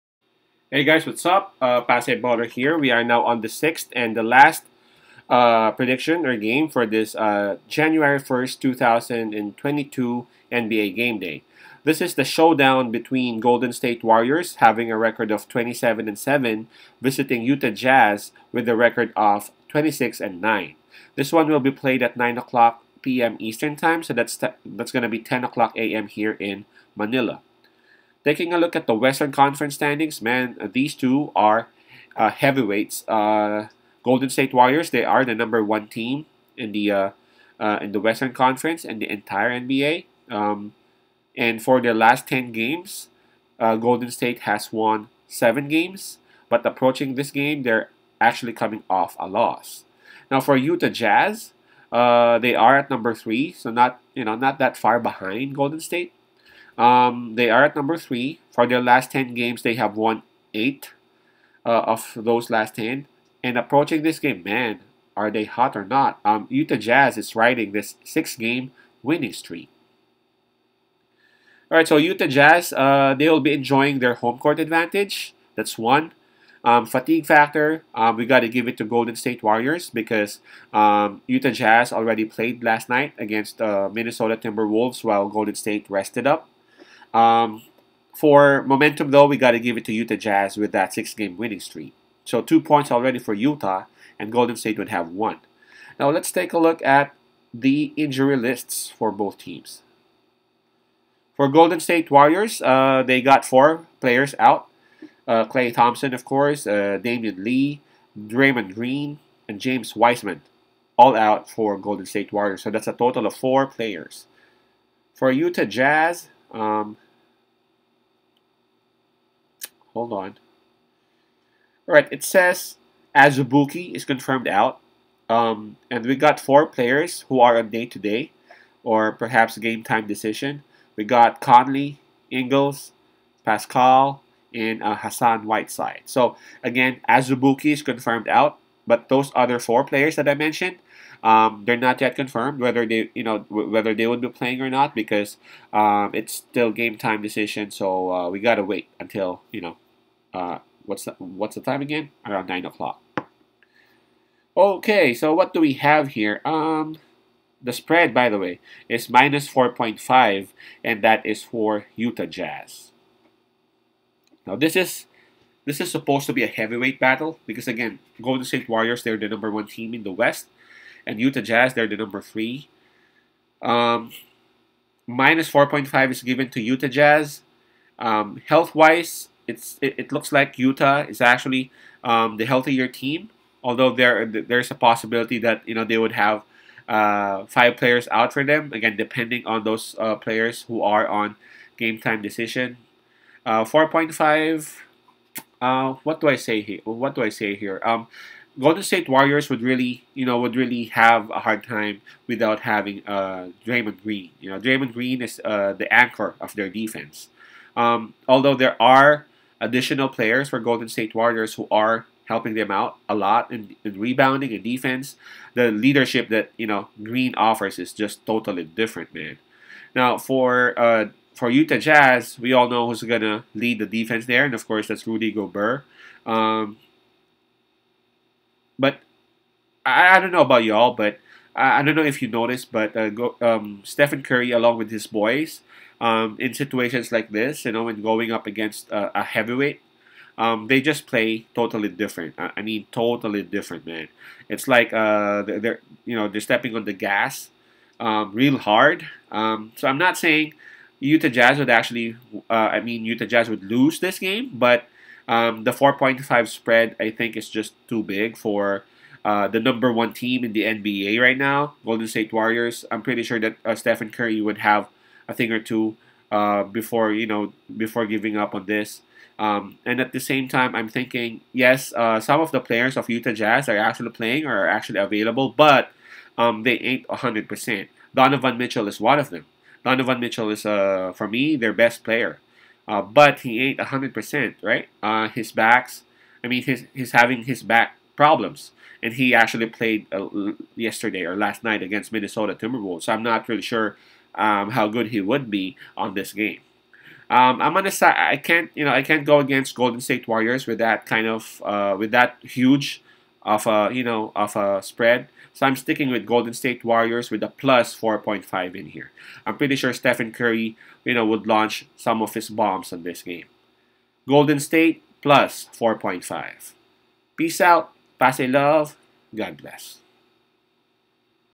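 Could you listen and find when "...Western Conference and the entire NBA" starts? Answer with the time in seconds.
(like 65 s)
37 s.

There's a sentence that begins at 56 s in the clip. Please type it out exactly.
Um, they are at number three.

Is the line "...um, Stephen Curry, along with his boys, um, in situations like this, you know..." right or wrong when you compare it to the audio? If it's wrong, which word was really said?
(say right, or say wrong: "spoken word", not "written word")
right.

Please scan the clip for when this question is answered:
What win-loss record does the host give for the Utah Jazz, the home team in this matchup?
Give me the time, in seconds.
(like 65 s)
19 s.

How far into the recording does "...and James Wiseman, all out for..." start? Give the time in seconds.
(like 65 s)
109 s.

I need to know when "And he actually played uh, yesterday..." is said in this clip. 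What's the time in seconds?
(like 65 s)
289 s.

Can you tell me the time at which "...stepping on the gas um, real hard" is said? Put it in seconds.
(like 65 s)
246 s.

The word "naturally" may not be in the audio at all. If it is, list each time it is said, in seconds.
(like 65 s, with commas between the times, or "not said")
not said.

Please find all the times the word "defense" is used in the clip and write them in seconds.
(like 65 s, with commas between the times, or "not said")
206 s, 214 s, 223 s.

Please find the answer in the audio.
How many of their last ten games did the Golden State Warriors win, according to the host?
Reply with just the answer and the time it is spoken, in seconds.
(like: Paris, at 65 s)
7, at 45 s.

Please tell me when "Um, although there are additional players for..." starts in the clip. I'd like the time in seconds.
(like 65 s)
207 s.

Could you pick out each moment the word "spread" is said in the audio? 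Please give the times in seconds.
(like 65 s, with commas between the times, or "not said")
157 s, 256 s, 304 s.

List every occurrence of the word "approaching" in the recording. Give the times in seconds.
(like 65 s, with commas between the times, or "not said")
46 s, 63 s.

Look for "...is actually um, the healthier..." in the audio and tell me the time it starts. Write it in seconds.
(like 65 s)
181 s.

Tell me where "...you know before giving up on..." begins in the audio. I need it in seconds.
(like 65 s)
267 s.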